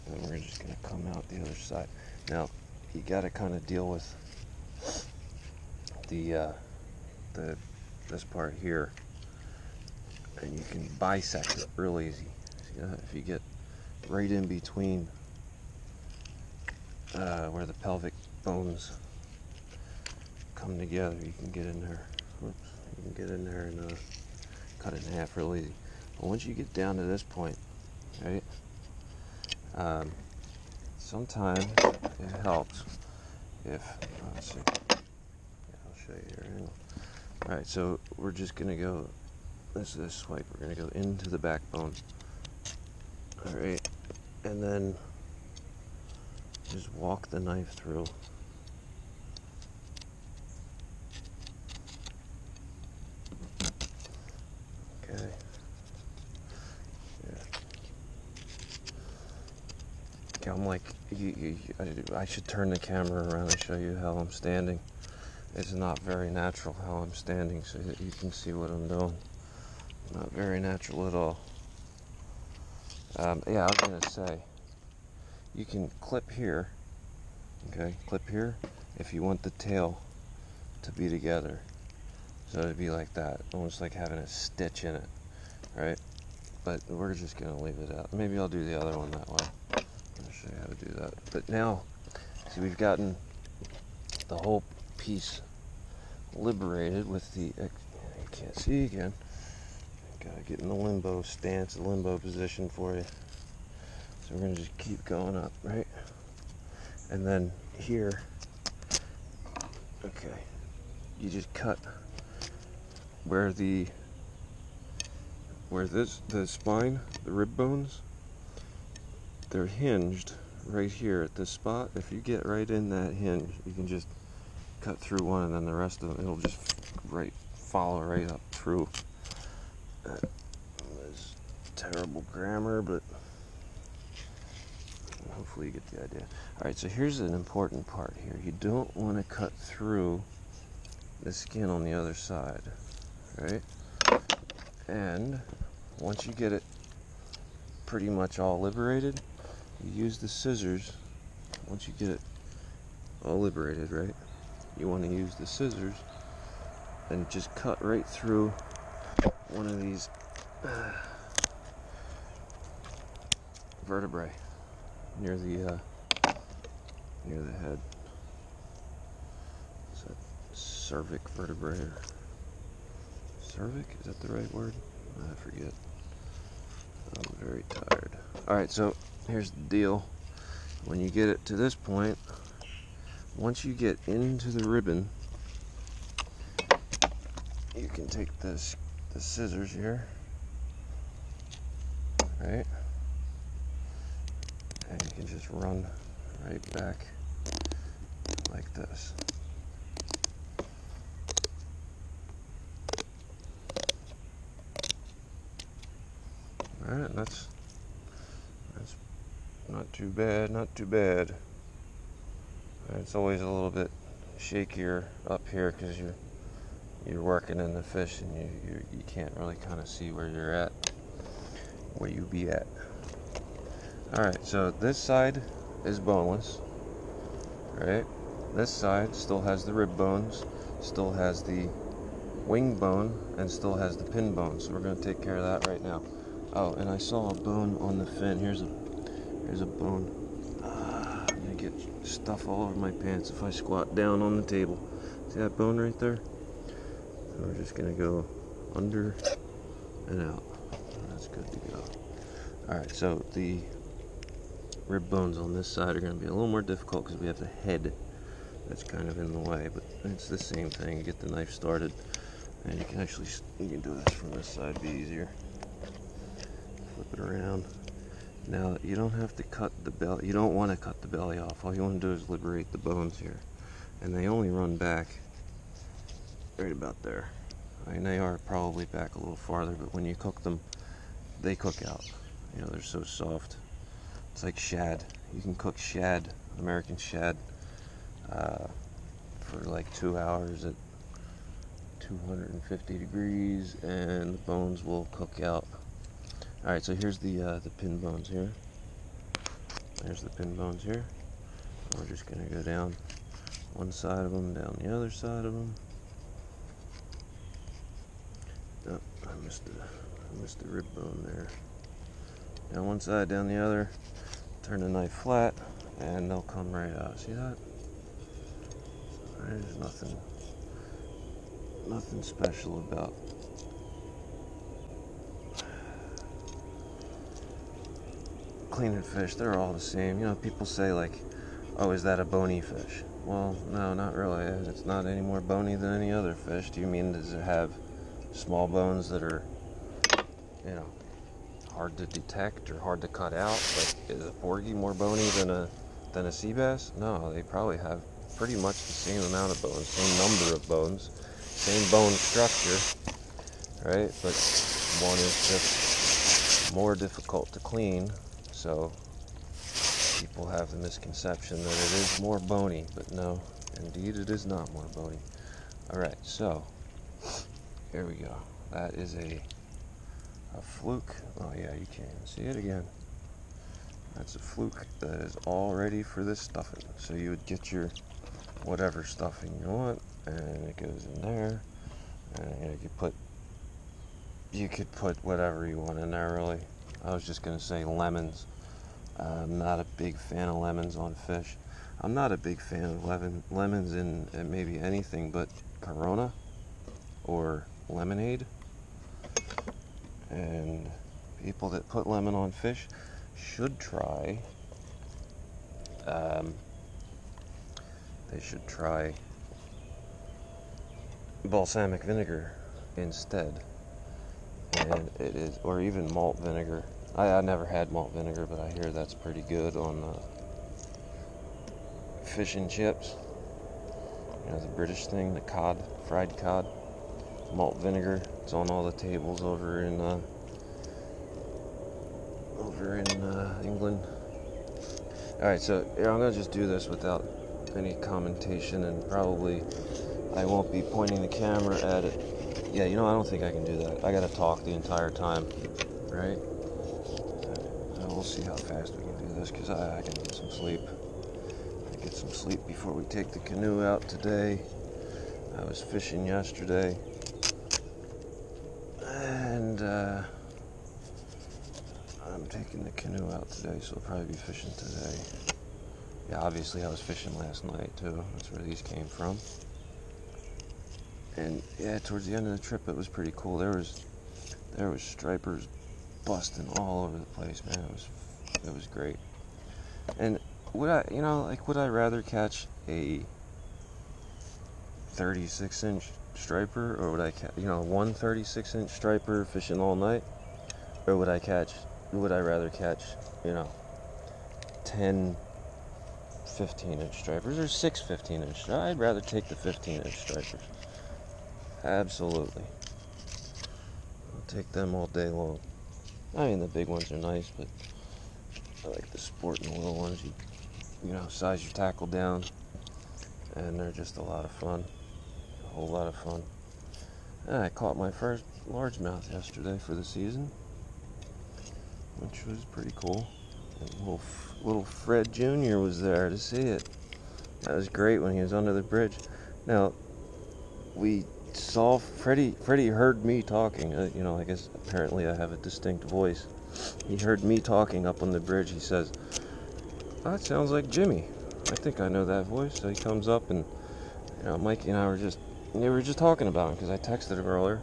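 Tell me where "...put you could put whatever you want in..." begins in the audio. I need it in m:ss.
6:22.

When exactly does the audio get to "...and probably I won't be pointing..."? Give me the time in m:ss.
7:18.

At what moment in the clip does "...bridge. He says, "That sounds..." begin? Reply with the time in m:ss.
8:58.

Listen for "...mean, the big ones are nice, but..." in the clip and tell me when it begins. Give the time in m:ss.
8:26.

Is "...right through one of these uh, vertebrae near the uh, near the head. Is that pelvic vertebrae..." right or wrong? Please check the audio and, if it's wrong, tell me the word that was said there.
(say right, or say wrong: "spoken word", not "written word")
wrong: "cervic", not "pelvic".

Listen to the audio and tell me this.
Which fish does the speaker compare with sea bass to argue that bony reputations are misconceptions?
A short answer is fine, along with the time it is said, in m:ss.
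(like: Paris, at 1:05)
porgy, at 5:44.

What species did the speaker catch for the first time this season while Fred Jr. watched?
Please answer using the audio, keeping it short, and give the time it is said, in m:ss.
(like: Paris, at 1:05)
largemouth, at 8:38.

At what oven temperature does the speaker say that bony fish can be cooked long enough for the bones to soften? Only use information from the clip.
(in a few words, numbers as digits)
250 degrees.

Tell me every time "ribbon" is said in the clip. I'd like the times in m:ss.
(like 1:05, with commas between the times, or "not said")
3:04.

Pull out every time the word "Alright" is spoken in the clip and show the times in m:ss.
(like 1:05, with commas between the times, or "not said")
3:44, 4:56, 6:05.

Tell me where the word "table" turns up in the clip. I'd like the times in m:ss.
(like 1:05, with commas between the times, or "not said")
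4:04, 7:08.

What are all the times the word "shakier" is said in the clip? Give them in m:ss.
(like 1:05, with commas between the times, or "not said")
3:34.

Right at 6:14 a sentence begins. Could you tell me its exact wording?
That's a fluke that is all ready for this stuffing.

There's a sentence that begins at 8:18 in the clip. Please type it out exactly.
I'd rather take the 15 inch stripers.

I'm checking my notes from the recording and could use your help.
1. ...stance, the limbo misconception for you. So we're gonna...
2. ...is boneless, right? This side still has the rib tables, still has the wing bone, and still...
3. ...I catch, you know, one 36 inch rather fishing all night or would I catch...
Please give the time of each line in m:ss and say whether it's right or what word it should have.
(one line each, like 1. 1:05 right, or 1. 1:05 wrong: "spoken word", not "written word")
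1. 1:41 wrong: "position", not "misconception"
2. 3:45 wrong: "bones", not "tables"
3. 8:07 wrong: "striper", not "rather".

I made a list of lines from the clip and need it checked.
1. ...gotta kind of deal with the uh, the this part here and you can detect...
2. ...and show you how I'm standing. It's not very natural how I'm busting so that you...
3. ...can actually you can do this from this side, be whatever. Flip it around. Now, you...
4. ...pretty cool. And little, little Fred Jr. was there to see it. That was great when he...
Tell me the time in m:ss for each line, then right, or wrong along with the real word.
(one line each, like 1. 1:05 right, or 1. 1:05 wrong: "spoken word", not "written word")
1. 0:03 wrong: "bisect", not "detect"
2. 1:03 wrong: "standing", not "busting"
3. 4:22 wrong: "easier", not "whatever"
4. 8:42 right.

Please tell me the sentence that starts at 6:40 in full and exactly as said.
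And people that put lemon on fish should try.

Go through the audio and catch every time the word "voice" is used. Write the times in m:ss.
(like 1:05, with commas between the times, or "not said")
8:56, 9:02.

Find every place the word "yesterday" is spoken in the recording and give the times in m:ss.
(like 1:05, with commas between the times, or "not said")
7:36, 8:39.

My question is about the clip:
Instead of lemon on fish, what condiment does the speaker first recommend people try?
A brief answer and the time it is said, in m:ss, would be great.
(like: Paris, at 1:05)
balsamic vinegar, at 6:51.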